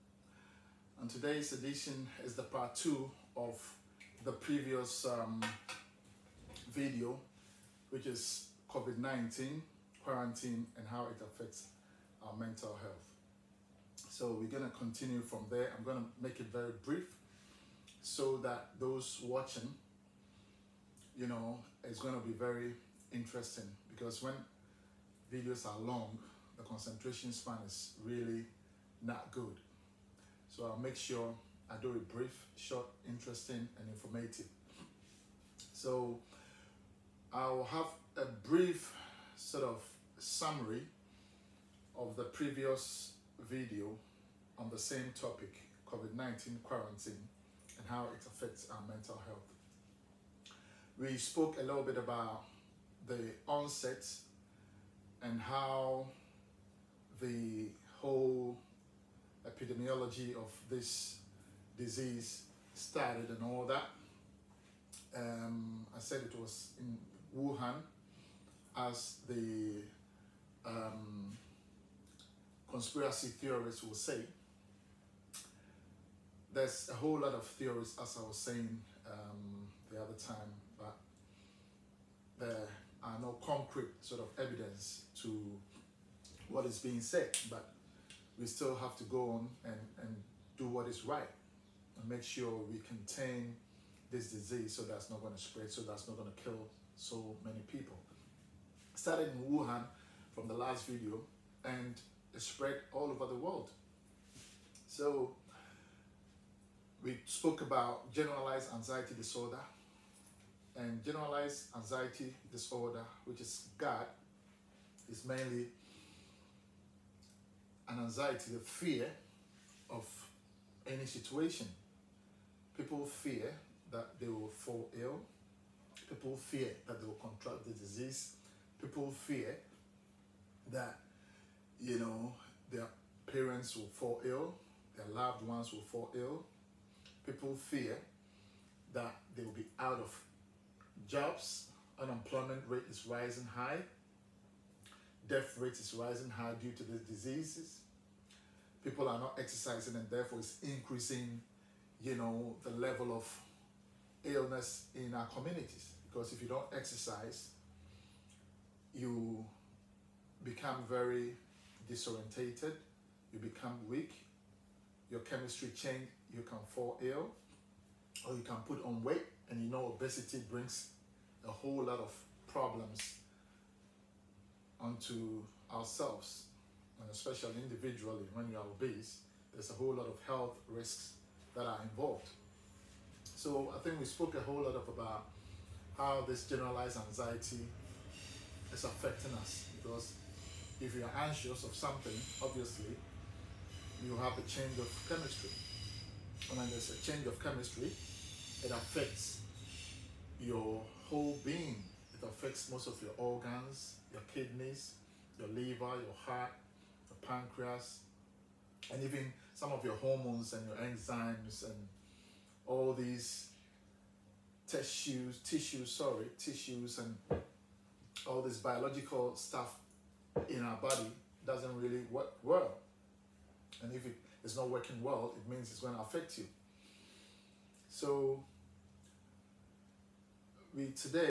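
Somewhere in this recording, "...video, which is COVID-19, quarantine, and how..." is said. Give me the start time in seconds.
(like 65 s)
6 s.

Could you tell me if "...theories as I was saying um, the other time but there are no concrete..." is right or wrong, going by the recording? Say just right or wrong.
right.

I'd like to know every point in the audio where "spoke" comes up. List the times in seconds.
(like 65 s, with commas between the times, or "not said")
51 s, 107 s, 184 s.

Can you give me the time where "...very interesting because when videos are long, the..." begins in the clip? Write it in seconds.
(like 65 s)
22 s.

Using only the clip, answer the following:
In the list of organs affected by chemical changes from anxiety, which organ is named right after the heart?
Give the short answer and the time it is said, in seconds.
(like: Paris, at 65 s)
pancreas, at 207 s.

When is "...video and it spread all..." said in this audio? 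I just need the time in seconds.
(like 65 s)
100 s.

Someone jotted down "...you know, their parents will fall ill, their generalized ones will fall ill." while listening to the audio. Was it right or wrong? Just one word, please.
wrong.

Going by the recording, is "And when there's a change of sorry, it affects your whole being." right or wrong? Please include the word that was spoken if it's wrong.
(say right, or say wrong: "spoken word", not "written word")
wrong: "chemistry", not "sorry".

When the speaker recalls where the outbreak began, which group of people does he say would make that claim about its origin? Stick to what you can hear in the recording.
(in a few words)
conspiracy theorists.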